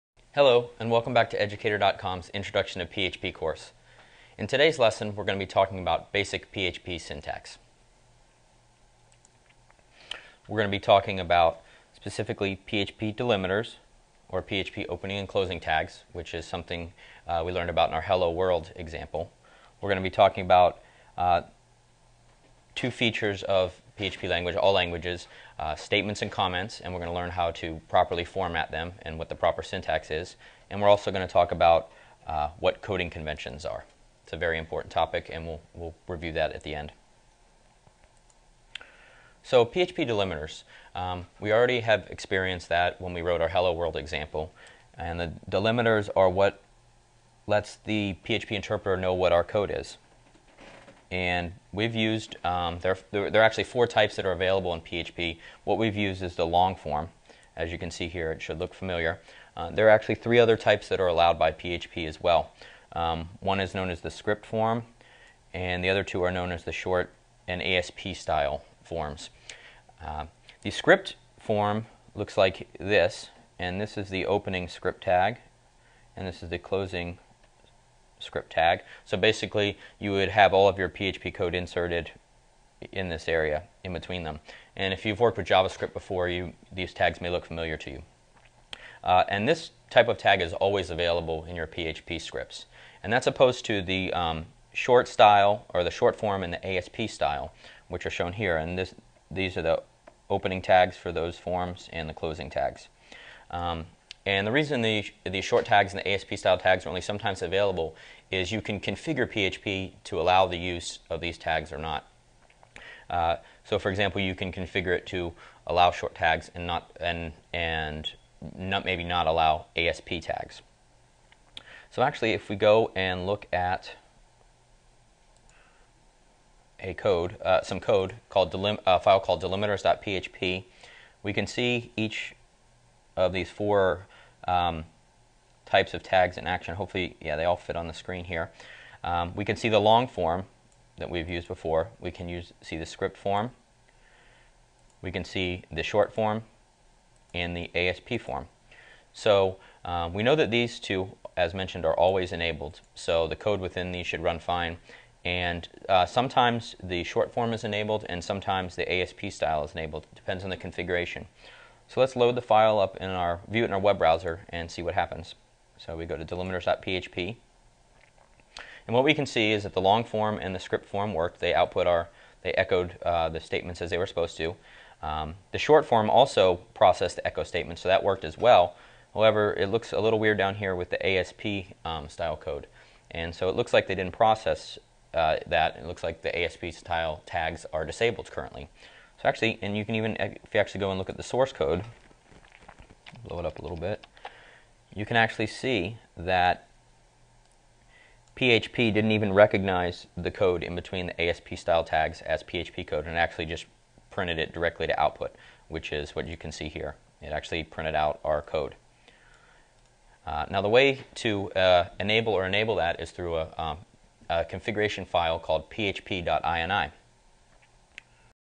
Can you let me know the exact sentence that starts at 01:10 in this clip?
Uh, the script form looks like this, and this is the opening script tag, and this is the closing script tag.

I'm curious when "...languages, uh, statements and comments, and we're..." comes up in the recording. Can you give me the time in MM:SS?
00:24.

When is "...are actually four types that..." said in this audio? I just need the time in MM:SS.
00:53.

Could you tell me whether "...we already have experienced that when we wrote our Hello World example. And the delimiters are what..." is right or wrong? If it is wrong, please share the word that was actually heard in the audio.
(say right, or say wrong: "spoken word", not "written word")
right.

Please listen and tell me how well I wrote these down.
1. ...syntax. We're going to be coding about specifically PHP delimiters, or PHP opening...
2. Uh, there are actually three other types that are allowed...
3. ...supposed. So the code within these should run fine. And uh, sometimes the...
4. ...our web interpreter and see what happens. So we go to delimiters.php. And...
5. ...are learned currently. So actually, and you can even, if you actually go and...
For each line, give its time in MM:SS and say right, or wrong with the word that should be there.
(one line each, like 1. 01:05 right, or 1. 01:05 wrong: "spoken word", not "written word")
1. 00:07 wrong: "talking", not "coding"
2. 00:59 right
3. 02:32 wrong: "enabled", not "supposed"
4. 02:43 wrong: "browser", not "interpreter"
5. 03:07 wrong: "disabled", not "learned".